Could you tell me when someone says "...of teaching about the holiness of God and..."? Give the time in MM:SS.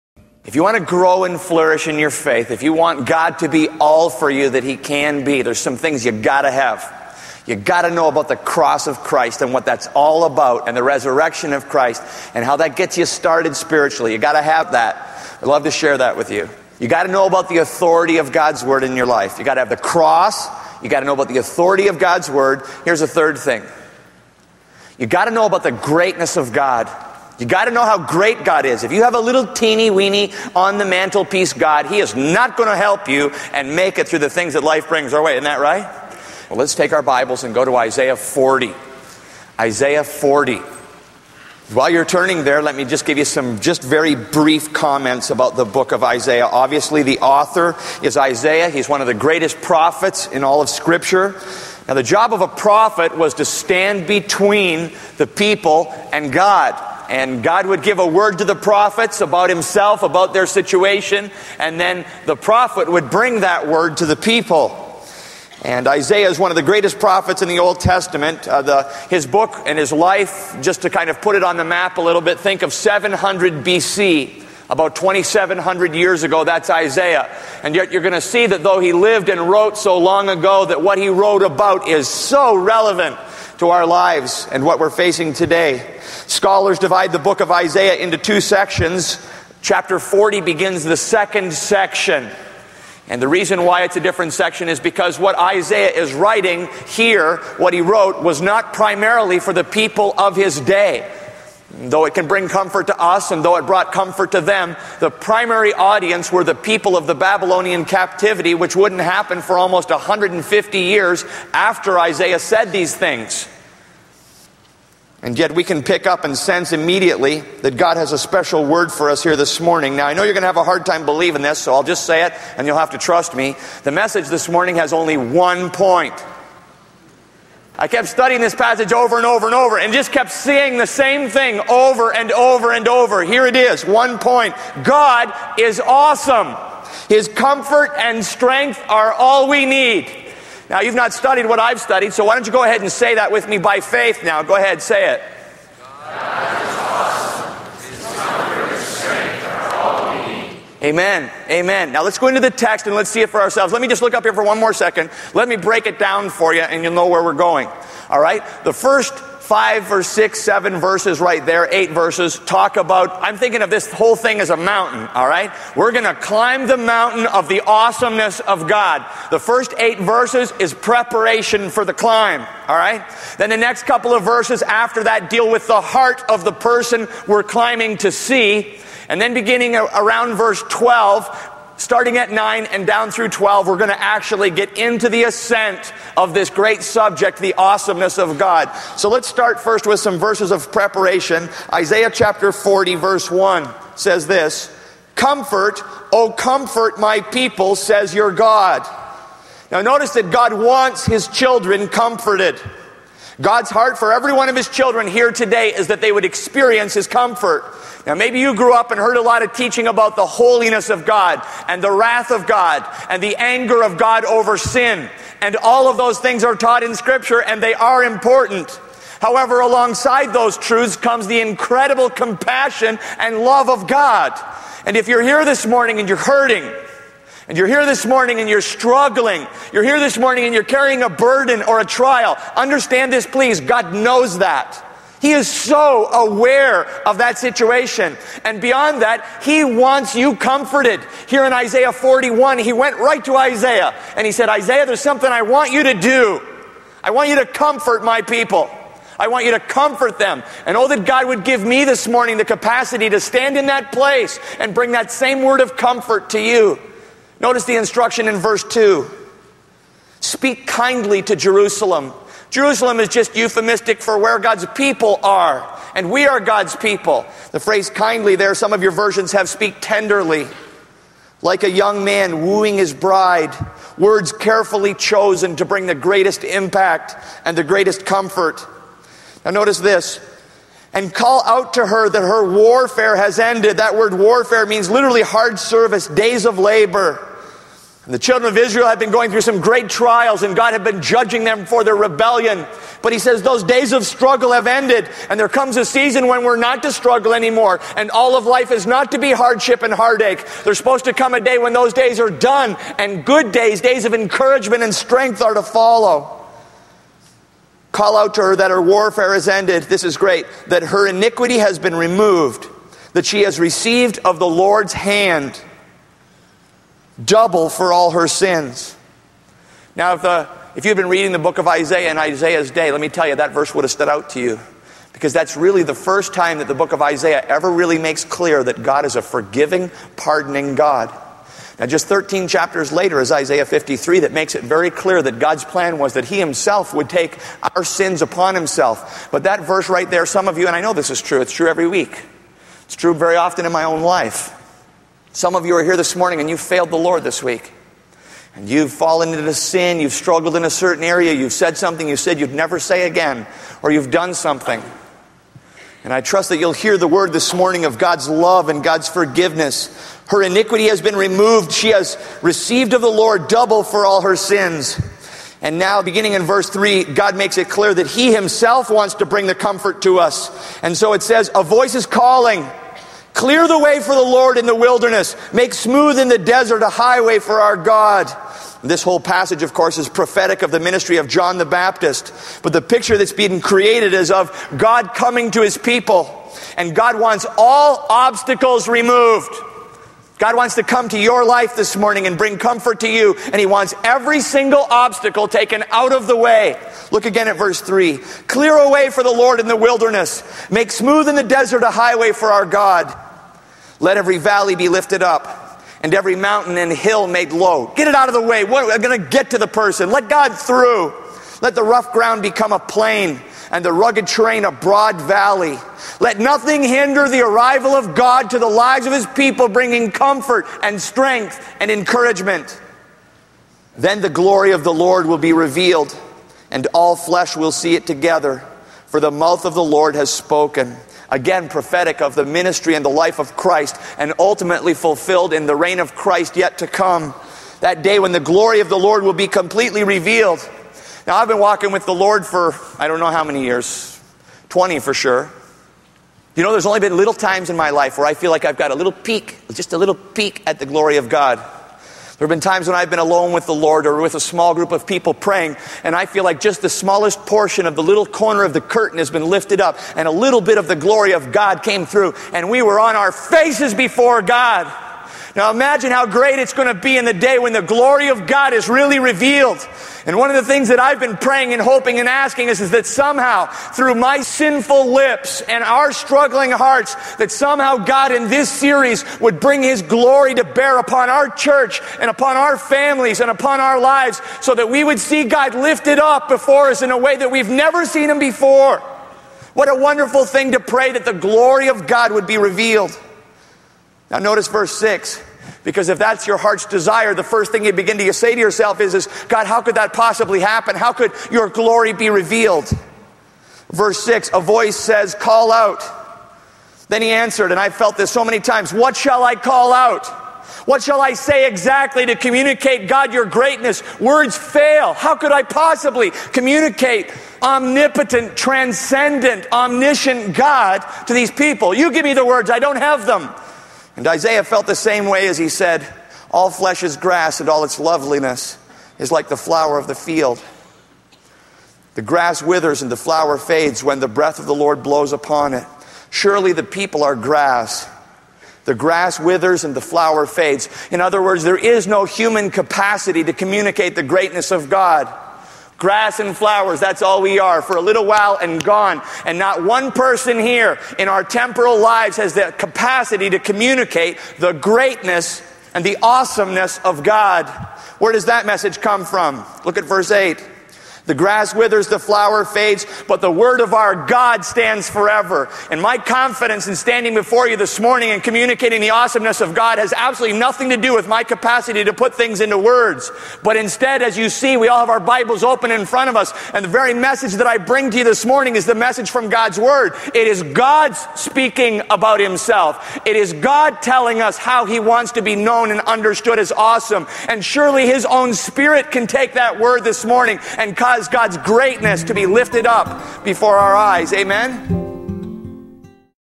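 03:29.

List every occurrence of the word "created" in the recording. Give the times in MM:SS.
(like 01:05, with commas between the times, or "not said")
06:23.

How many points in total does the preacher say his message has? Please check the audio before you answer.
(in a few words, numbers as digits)
1.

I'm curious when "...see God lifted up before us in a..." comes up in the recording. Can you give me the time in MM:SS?
08:05.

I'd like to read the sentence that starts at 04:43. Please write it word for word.
That word warfare means literally hard service, days of labor.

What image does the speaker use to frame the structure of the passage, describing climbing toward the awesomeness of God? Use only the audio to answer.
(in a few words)
A mountain.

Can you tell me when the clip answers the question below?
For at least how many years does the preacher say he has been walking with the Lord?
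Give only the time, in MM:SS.
07:24.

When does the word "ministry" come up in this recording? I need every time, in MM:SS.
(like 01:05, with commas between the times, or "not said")
06:20, 07:12.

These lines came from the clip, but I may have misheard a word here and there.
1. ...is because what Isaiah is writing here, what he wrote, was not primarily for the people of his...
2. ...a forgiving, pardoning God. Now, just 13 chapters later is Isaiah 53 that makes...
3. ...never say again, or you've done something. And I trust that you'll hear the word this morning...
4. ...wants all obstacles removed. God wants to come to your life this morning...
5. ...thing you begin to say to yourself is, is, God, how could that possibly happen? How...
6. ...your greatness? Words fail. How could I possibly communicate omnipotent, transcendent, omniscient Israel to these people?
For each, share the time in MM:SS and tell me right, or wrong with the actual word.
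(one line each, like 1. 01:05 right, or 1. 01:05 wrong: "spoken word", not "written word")
1. 01:34 right
2. 05:29 right
3. 05:52 right
4. 06:27 right
5. 08:17 right
6. 08:33 wrong: "God", not "Israel".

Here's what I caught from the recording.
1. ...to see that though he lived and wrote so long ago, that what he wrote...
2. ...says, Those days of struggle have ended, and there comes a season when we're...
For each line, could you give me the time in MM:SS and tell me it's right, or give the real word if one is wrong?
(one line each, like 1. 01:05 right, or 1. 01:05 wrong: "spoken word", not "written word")
1. 01:18 right
2. 04:53 right.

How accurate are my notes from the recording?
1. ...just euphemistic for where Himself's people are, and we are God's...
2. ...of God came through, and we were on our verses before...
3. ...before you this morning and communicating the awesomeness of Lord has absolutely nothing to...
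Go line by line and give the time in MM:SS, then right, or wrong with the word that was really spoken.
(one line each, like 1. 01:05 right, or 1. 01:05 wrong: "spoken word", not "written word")
1. 04:23 wrong: "God", not "Himself"
2. 07:41 wrong: "faces", not "verses"
3. 09:27 wrong: "God", not "Lord".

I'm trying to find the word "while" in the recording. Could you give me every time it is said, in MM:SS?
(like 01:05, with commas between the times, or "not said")
00:41, 09:08.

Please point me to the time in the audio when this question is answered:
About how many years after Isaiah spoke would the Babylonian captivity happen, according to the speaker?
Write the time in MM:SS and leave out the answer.
01:49.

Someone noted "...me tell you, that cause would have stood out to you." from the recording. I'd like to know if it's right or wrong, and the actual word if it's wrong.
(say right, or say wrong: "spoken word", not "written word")
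wrong: "verse", not "cause".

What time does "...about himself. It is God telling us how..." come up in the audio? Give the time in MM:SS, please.
09:42.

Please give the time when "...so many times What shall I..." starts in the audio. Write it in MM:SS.
08:28.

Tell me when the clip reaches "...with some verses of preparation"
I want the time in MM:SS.
03:09.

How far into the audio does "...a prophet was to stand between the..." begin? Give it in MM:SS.
00:52.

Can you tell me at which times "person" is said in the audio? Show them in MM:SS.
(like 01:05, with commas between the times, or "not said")
02:56, 06:49, 09:10.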